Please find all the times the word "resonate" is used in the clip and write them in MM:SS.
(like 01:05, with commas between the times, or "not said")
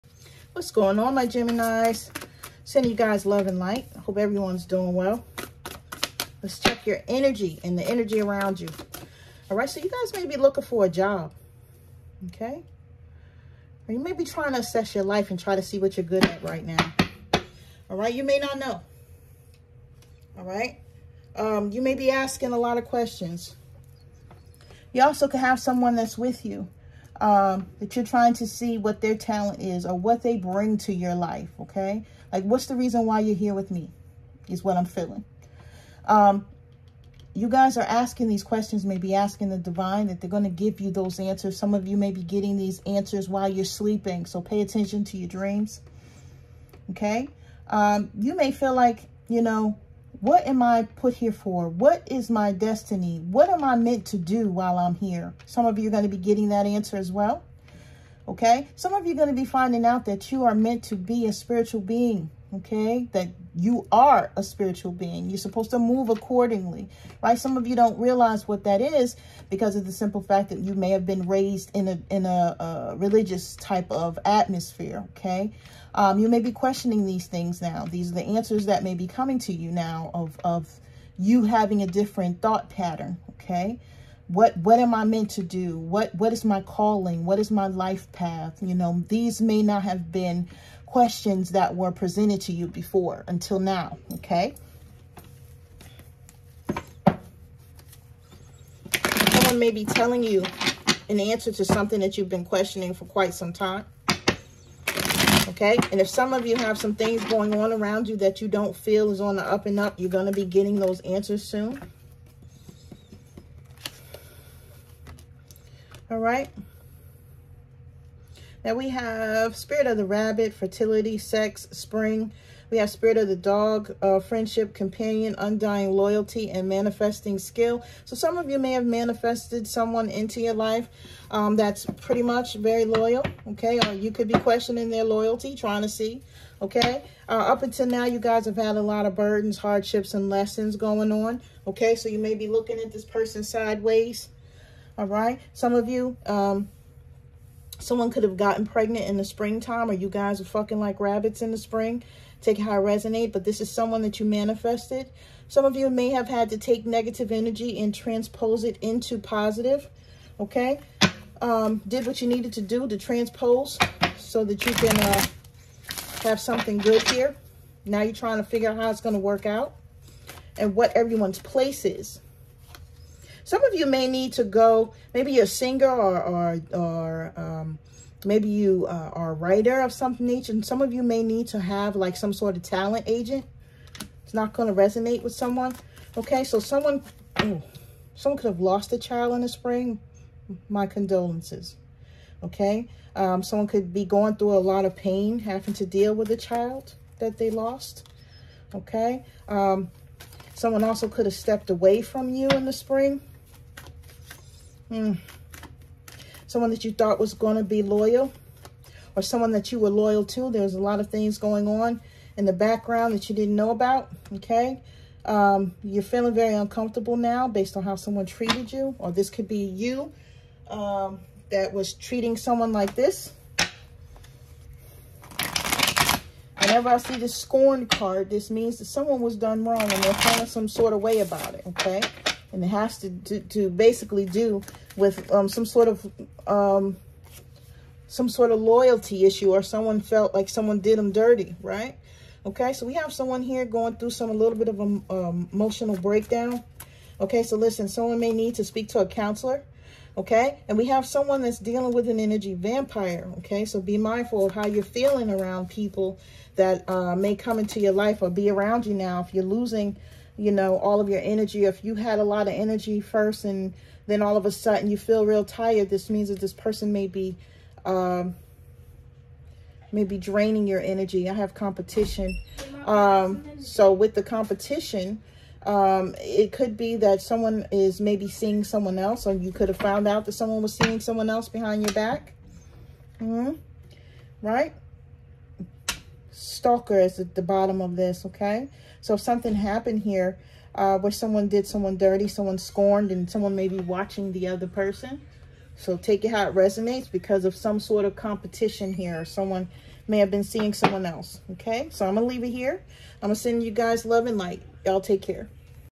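02:32, 03:04, 04:56.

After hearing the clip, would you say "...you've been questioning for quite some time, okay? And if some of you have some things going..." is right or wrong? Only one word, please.
right.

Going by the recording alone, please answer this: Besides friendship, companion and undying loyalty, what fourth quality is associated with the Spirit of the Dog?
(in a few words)
Manifesting Skill.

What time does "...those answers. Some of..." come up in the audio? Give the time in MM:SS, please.
00:40.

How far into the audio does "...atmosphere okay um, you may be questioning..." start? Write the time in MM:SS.
01:14.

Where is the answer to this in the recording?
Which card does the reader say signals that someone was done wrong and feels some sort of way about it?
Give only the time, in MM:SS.
03:47.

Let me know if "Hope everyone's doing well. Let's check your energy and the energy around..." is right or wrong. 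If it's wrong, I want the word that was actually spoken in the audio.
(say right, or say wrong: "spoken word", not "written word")
right.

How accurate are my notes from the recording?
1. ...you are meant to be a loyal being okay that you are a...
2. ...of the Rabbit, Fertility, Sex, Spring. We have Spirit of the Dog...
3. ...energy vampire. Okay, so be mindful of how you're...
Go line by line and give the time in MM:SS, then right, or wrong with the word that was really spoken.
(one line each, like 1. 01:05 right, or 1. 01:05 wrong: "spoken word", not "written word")
1. 01:00 wrong: "spiritual", not "loyal"
2. 01:59 right
3. 04:12 right.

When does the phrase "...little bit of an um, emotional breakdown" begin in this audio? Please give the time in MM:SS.
04:04.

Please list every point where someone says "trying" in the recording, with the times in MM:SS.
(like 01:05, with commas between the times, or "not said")
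00:14, 00:28, 02:15, 02:48.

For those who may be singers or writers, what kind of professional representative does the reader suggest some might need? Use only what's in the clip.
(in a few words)
talent agent.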